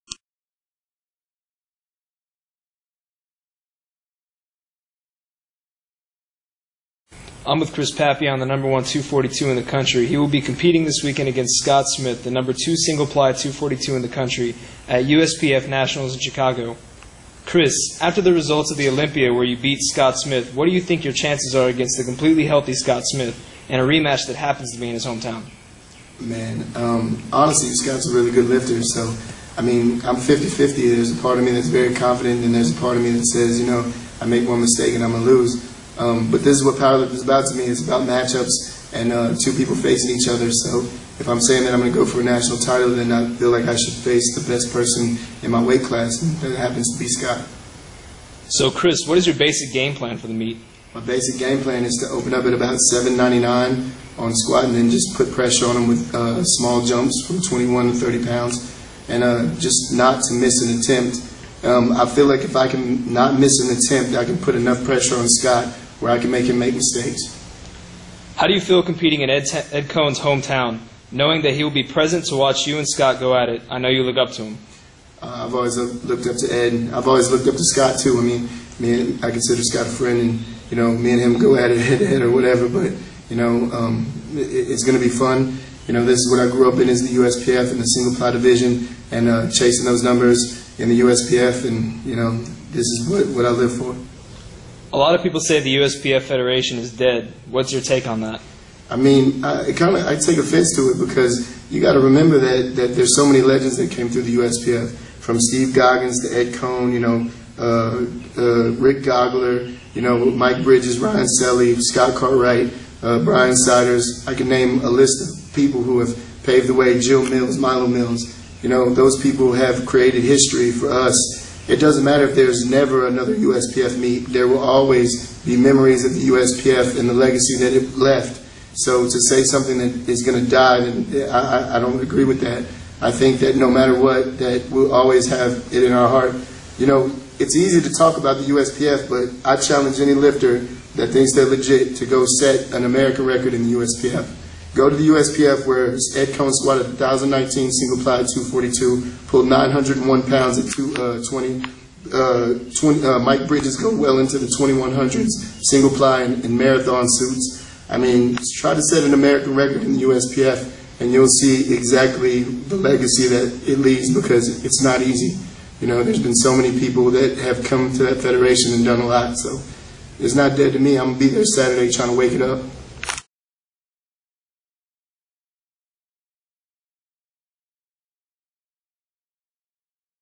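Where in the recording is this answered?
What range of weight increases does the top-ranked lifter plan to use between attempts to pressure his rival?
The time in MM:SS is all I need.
00:57.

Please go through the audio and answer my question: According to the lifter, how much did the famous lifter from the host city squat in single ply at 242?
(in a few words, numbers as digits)
1,019.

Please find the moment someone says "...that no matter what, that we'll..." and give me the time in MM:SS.
02:13.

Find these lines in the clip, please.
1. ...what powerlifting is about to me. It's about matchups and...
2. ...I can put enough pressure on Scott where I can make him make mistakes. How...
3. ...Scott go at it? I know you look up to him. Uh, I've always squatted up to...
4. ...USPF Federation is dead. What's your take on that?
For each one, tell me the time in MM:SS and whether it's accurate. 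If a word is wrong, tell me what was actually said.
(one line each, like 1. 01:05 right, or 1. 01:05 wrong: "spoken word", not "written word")
1. 00:36 right
2. 01:04 right
3. 01:12 wrong: "looked", not "squatted"
4. 01:35 right.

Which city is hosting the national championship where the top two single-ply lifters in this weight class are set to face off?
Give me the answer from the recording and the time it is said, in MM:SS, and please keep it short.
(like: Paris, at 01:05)
Chicago, at 00:16.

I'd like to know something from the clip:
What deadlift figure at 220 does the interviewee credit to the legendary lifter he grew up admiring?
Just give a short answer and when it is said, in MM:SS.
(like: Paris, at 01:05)
901 pounds, at 02:29.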